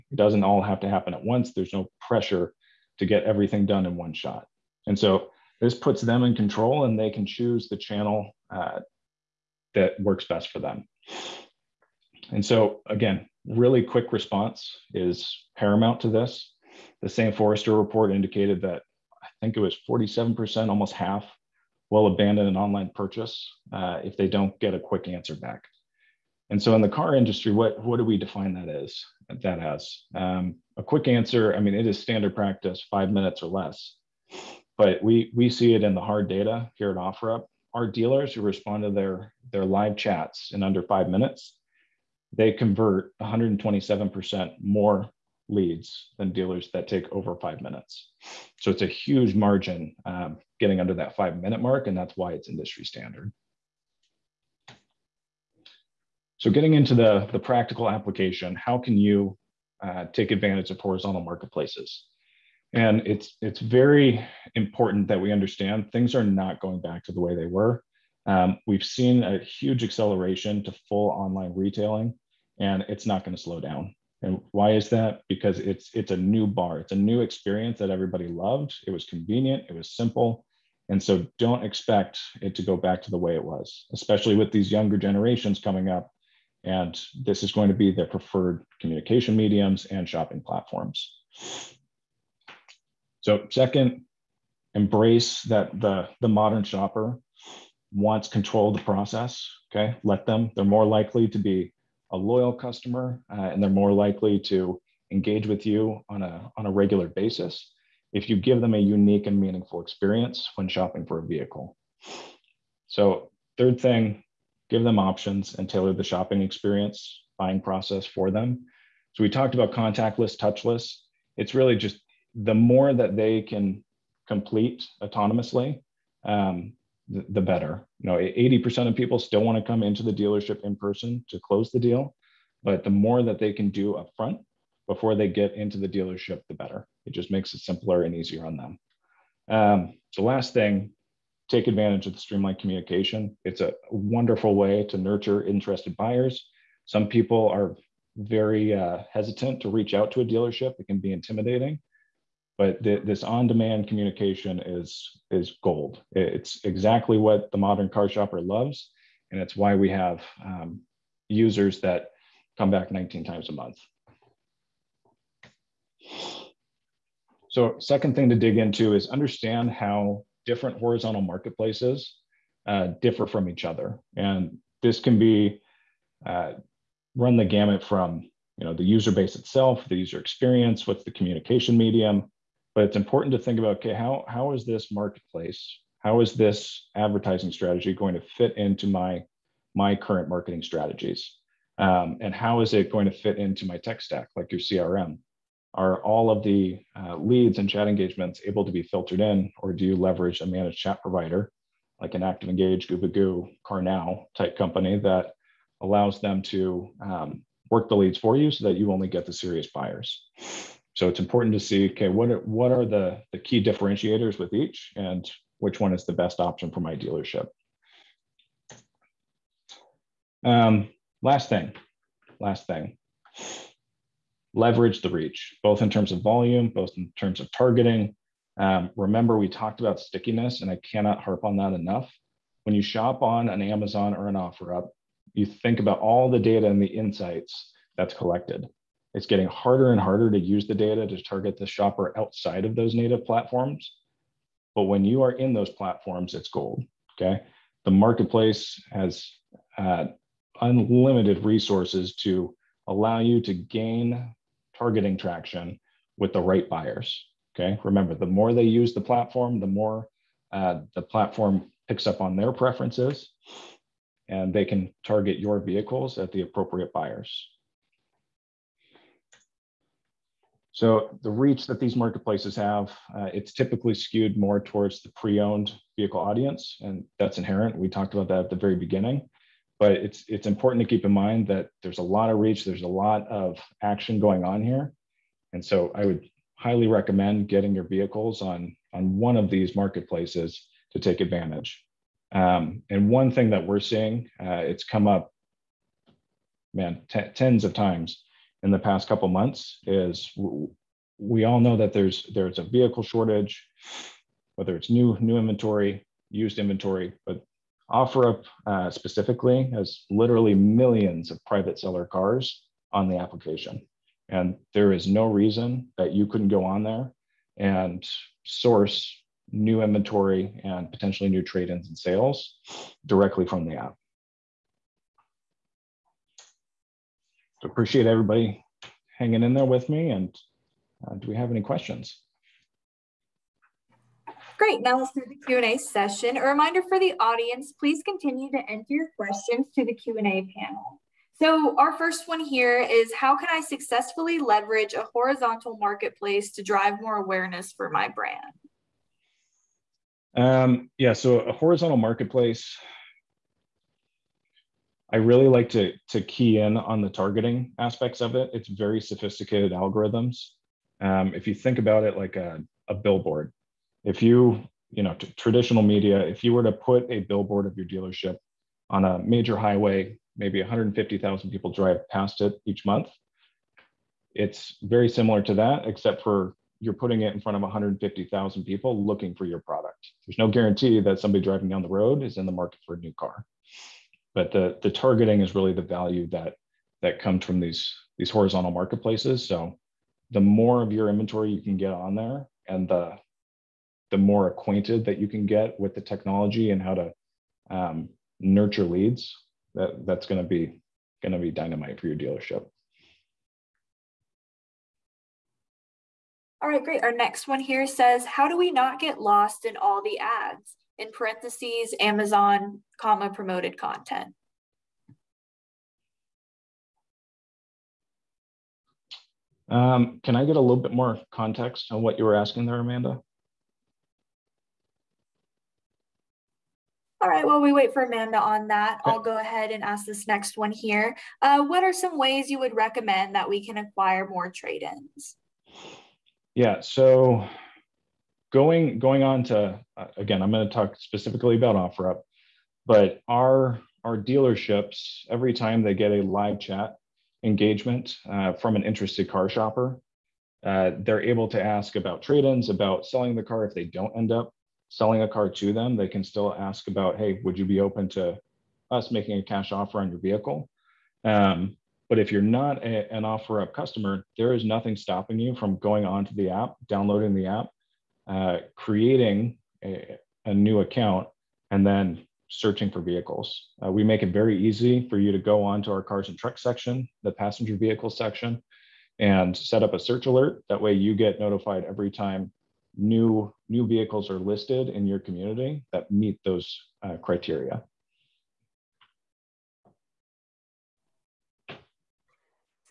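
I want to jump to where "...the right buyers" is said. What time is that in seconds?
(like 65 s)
256 s.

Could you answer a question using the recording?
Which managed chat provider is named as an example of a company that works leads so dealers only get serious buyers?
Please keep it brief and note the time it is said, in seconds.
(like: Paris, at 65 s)
ActivEngage, at 202 s.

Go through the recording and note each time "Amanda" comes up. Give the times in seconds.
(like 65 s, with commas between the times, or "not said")
422 s, 428 s.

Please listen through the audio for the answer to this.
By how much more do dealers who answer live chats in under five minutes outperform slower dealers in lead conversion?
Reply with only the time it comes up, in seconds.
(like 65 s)
43 s.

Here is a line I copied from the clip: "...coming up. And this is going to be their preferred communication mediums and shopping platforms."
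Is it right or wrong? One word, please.
right.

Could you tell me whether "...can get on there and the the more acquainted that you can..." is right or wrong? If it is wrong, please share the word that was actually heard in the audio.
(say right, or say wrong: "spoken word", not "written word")
right.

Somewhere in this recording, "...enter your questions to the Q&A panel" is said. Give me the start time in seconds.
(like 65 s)
338 s.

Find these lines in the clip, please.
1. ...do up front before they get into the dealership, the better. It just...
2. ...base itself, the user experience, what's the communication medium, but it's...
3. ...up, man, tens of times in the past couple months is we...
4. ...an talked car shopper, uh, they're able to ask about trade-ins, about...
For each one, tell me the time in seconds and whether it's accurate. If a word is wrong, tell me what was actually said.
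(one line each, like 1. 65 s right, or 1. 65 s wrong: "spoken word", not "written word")
1. 133 s right
2. 179 s right
3. 295 s right
4. 448 s wrong: "interested", not "talked".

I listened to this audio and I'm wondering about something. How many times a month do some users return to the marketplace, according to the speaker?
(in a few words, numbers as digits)
19.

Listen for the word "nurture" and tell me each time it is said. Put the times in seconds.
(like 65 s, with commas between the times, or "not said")
144 s, 398 s.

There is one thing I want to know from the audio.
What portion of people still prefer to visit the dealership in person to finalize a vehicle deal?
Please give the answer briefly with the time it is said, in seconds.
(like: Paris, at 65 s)
80%, at 128 s.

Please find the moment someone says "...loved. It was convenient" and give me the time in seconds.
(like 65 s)
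78 s.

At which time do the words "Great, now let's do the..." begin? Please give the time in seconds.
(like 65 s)
334 s.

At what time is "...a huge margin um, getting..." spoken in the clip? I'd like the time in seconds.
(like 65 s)
48 s.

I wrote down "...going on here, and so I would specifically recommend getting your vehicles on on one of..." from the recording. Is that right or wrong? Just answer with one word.
wrong.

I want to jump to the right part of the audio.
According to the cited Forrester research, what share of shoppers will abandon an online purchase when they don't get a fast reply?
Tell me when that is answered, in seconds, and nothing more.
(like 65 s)
19 s.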